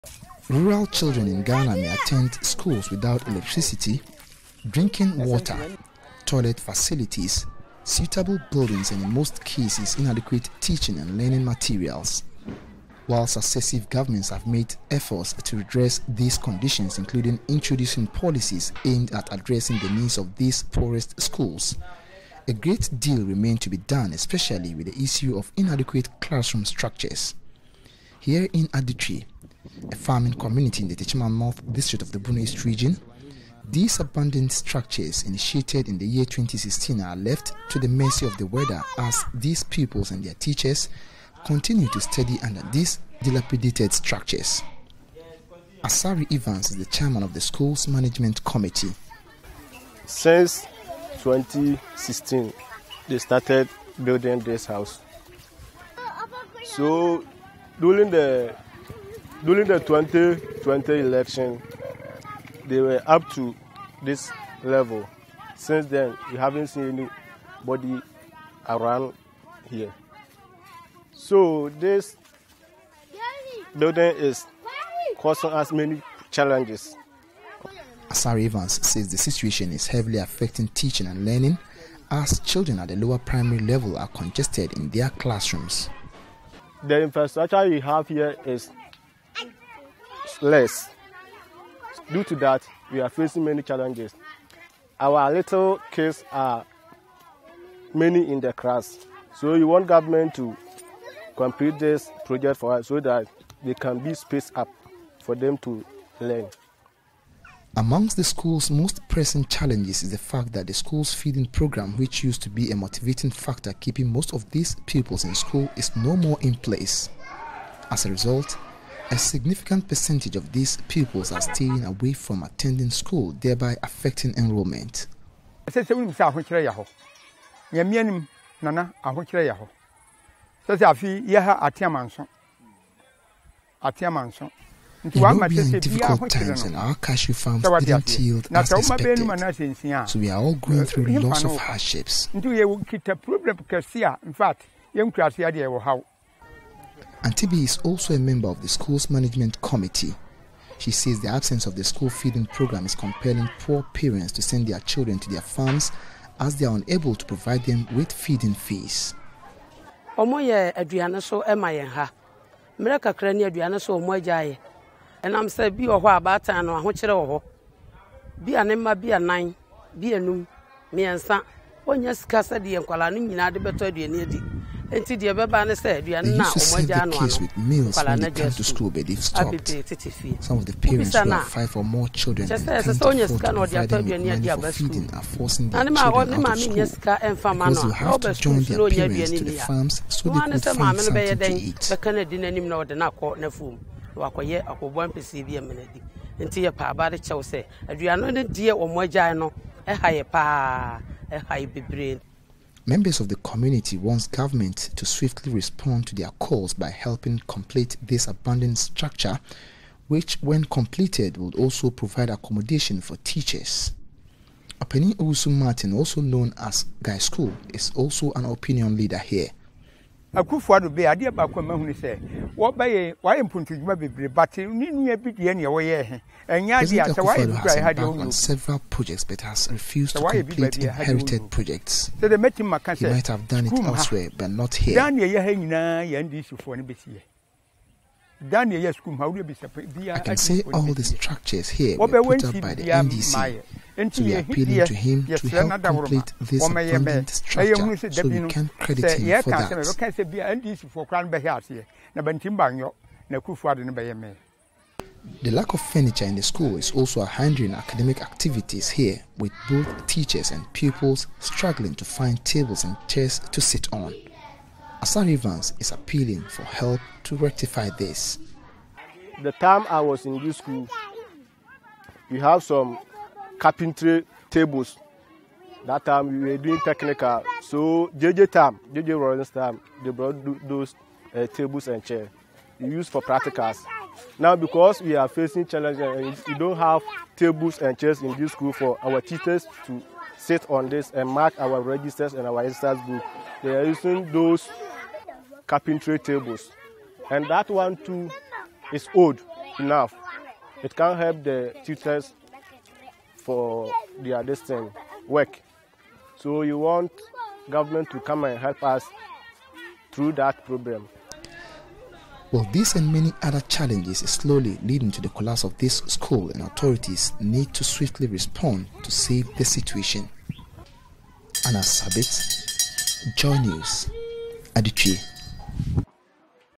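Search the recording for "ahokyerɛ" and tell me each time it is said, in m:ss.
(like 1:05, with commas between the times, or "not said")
2:09, 2:16, 2:46.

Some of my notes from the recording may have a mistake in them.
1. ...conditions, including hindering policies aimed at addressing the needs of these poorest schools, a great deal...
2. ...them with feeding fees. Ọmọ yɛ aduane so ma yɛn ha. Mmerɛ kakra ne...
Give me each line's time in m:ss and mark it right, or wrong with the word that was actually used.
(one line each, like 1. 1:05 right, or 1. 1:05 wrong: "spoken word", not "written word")
1. 0:16 wrong: "introducing", not "hindering"
2. 2:37 right.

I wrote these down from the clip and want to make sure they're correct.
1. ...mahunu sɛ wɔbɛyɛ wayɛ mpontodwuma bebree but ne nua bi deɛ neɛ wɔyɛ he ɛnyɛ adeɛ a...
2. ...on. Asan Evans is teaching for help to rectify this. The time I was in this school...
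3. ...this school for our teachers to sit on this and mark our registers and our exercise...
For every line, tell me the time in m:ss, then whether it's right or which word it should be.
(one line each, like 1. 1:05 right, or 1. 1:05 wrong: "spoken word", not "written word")
1. 3:41 right
2. 4:23 wrong: "appealing", not "teaching"
3. 4:48 right.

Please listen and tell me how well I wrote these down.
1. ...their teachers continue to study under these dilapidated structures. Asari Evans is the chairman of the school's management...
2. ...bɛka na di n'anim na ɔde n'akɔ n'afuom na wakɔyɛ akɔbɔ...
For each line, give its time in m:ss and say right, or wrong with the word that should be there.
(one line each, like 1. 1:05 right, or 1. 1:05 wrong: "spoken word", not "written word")
1. 0:40 right
2. 3:11 right.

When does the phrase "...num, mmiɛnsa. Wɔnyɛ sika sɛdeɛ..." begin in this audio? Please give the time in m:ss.
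2:50.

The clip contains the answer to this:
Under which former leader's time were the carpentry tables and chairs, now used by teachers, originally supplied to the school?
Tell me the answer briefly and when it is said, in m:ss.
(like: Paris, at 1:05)
JJ Rawlings, at 4:38.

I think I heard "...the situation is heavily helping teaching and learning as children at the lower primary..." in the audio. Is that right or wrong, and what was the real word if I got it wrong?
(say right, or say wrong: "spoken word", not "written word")
wrong: "affecting", not "helping".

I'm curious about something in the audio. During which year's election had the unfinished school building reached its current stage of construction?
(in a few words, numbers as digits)
2020.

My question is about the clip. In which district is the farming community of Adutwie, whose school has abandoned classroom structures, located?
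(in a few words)
Techiman North.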